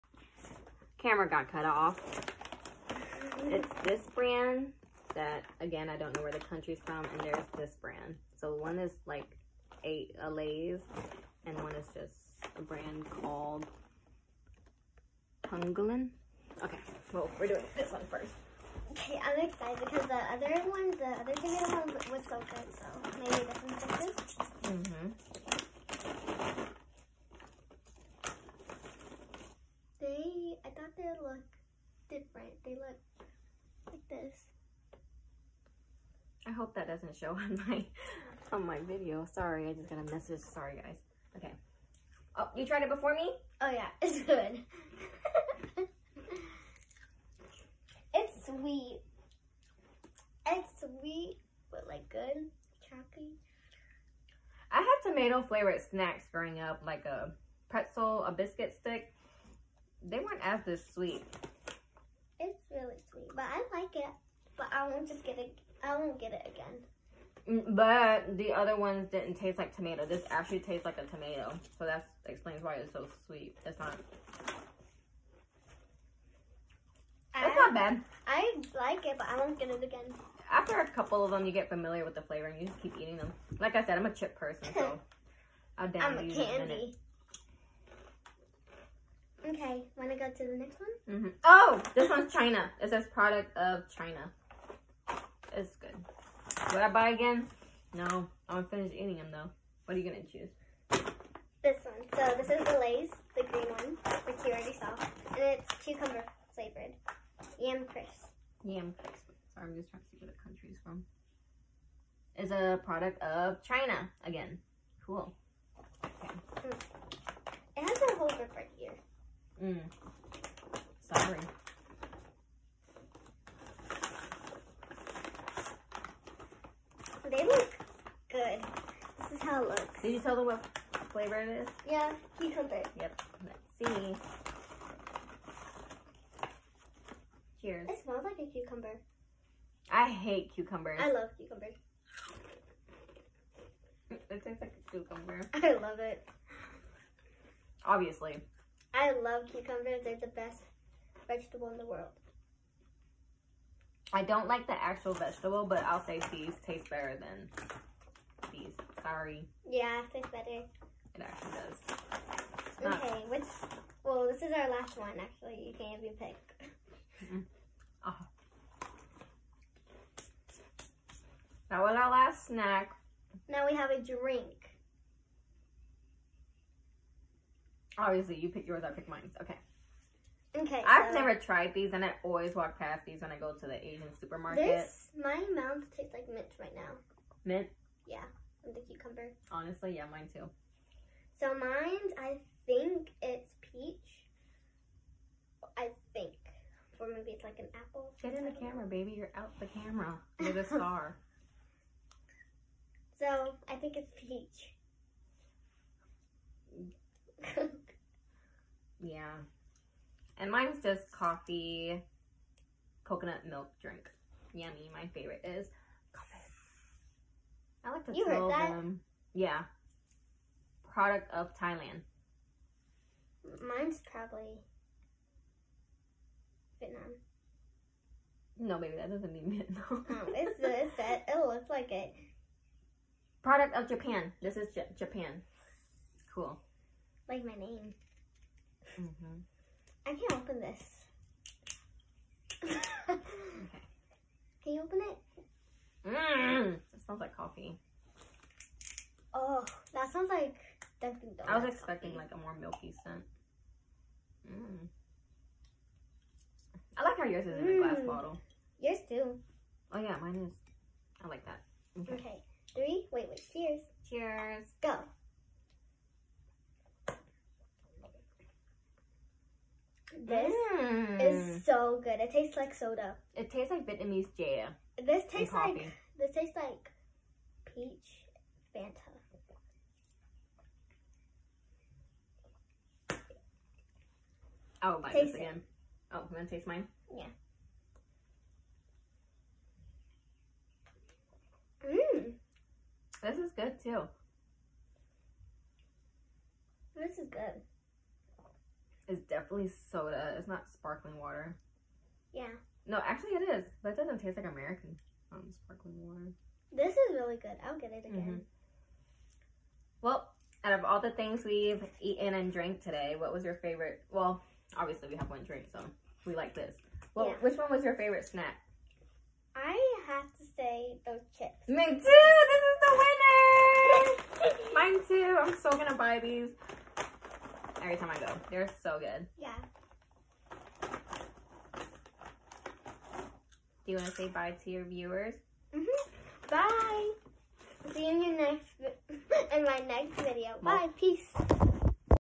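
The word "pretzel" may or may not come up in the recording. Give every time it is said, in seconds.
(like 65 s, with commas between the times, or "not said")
57 s.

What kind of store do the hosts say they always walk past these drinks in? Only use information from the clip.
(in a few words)
Asian supermarket.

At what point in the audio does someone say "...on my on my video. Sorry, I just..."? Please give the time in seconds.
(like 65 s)
37 s.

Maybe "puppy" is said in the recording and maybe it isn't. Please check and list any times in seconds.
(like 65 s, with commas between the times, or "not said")
not said.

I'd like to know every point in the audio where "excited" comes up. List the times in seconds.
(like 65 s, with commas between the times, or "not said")
19 s.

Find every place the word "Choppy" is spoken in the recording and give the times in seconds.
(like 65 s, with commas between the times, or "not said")
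52 s.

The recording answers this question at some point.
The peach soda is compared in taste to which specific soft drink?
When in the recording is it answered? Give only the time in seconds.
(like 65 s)
277 s.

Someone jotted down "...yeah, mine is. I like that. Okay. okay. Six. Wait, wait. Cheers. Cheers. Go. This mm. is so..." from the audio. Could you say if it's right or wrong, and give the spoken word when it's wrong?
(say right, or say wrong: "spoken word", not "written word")
wrong: "Three", not "Six".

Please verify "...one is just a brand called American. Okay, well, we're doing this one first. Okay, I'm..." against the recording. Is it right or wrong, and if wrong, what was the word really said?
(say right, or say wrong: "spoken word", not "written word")
wrong: "Pungolin", not "American".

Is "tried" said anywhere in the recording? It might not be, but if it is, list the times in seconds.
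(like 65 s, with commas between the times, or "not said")
42 s, 181 s.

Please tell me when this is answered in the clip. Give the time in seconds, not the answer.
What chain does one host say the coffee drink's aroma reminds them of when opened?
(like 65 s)
251 s.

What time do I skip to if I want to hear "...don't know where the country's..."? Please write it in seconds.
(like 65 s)
5 s.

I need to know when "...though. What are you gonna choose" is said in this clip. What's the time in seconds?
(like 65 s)
99 s.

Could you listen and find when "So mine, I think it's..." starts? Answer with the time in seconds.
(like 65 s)
191 s.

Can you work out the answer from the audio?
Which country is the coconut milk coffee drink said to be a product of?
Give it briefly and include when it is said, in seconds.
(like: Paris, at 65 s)
Thailand, at 220 s.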